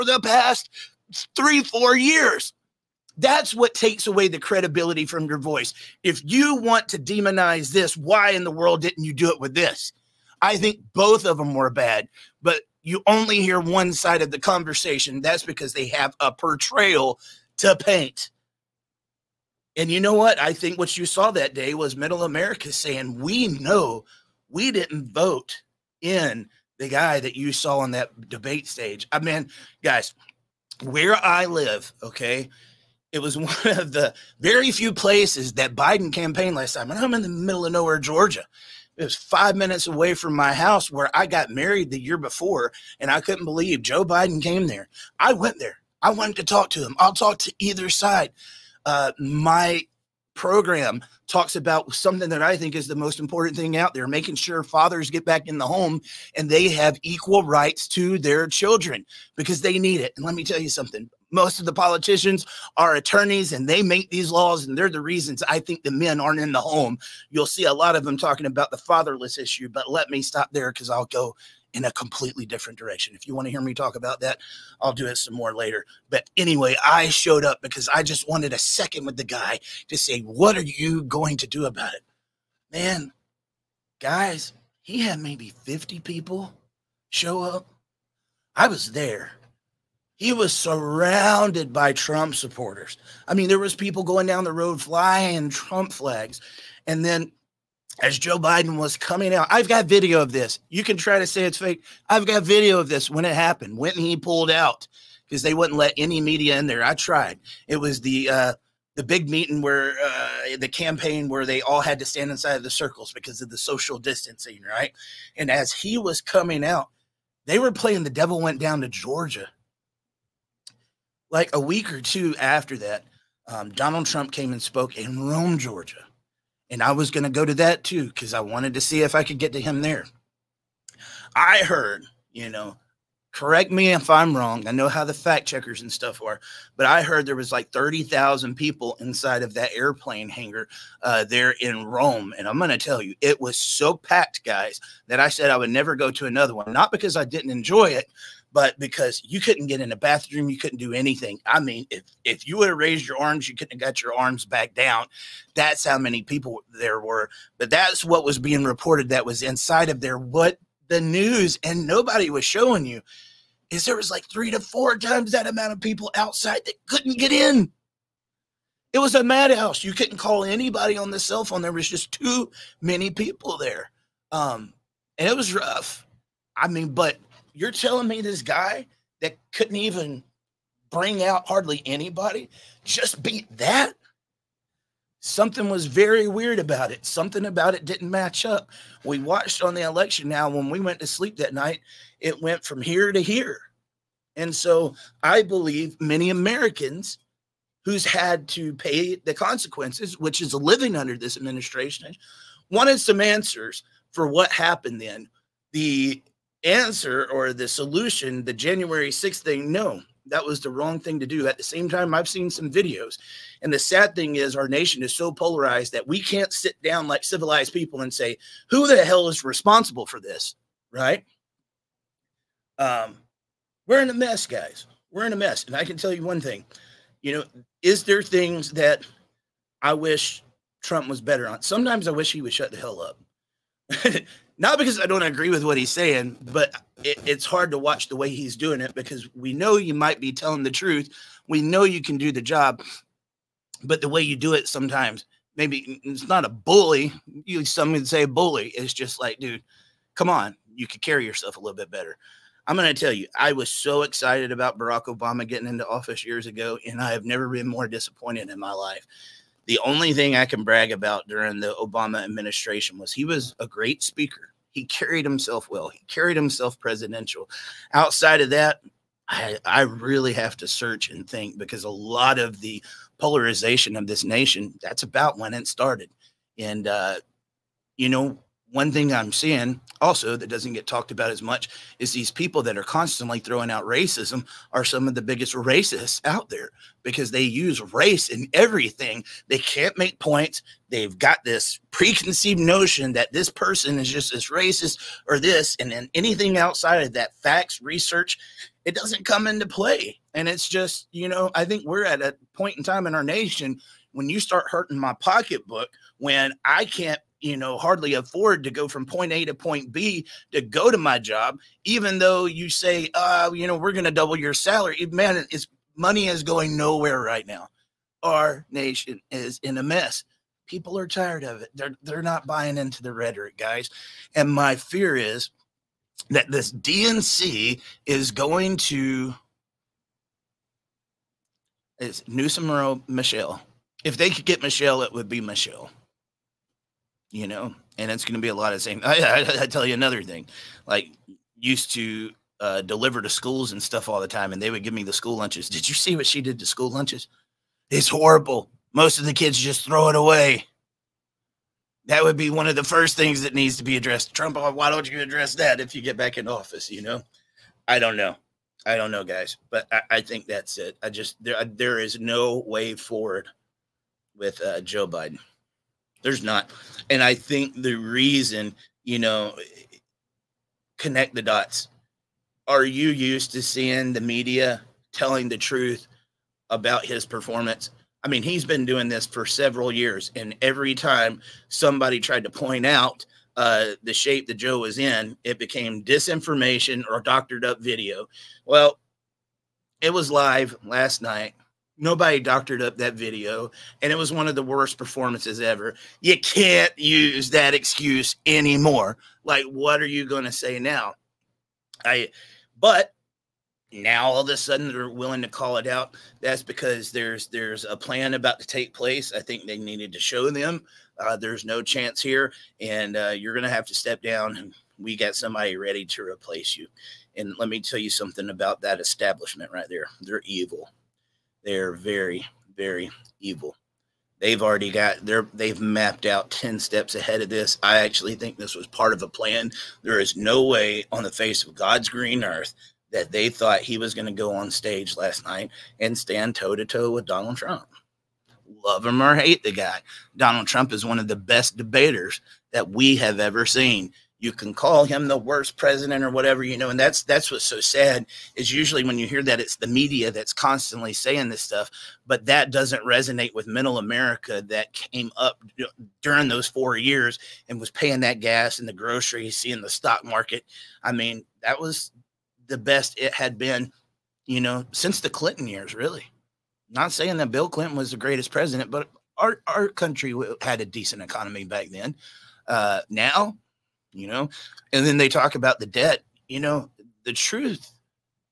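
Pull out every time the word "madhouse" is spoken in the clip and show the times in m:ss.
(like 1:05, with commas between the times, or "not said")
2:49.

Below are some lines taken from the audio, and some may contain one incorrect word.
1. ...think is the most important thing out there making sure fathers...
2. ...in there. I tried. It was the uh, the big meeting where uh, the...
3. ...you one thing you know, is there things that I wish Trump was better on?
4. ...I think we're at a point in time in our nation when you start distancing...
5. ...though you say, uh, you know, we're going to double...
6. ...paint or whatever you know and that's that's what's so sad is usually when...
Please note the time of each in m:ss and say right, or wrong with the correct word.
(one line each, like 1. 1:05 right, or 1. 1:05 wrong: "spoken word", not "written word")
1. 0:52 right
2. 1:46 right
3. 3:46 right
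4. 5:01 wrong: "hurting", not "distancing"
5. 5:12 right
6. 7:25 wrong: "president", not "paint".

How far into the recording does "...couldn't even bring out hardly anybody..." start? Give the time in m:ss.
2:59.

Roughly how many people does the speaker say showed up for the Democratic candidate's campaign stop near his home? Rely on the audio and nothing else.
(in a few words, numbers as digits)
50.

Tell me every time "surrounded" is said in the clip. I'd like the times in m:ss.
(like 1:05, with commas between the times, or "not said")
1:30.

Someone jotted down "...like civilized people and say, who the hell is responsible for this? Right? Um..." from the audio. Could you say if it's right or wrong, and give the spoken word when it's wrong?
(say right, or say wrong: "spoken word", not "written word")
right.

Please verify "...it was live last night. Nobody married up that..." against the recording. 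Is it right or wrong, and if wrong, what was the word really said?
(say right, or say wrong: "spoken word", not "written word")
wrong: "doctored", not "married".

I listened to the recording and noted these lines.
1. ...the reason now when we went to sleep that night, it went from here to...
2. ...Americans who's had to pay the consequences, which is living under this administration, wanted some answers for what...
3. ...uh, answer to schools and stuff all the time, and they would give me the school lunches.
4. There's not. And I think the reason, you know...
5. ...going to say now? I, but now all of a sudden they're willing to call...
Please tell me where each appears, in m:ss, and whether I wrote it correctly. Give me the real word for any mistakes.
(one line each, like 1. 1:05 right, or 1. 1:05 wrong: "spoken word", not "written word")
1. 3:09 wrong: "election", not "reason"
2. 3:16 right
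3. 5:42 wrong: "deliver", not "answer"
4. 6:06 right
5. 6:40 right.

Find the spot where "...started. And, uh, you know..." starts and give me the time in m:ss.
4:35.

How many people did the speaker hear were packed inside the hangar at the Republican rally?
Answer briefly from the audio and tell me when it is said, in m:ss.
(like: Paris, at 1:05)
30,000, at 2:17.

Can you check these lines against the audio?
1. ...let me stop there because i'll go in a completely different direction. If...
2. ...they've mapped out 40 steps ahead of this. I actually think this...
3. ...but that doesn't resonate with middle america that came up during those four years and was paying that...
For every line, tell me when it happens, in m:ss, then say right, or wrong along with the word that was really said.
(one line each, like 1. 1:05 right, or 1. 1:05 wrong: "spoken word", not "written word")
1. 1:09 right
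2. 7:05 wrong: "10", not "40"
3. 7:32 right.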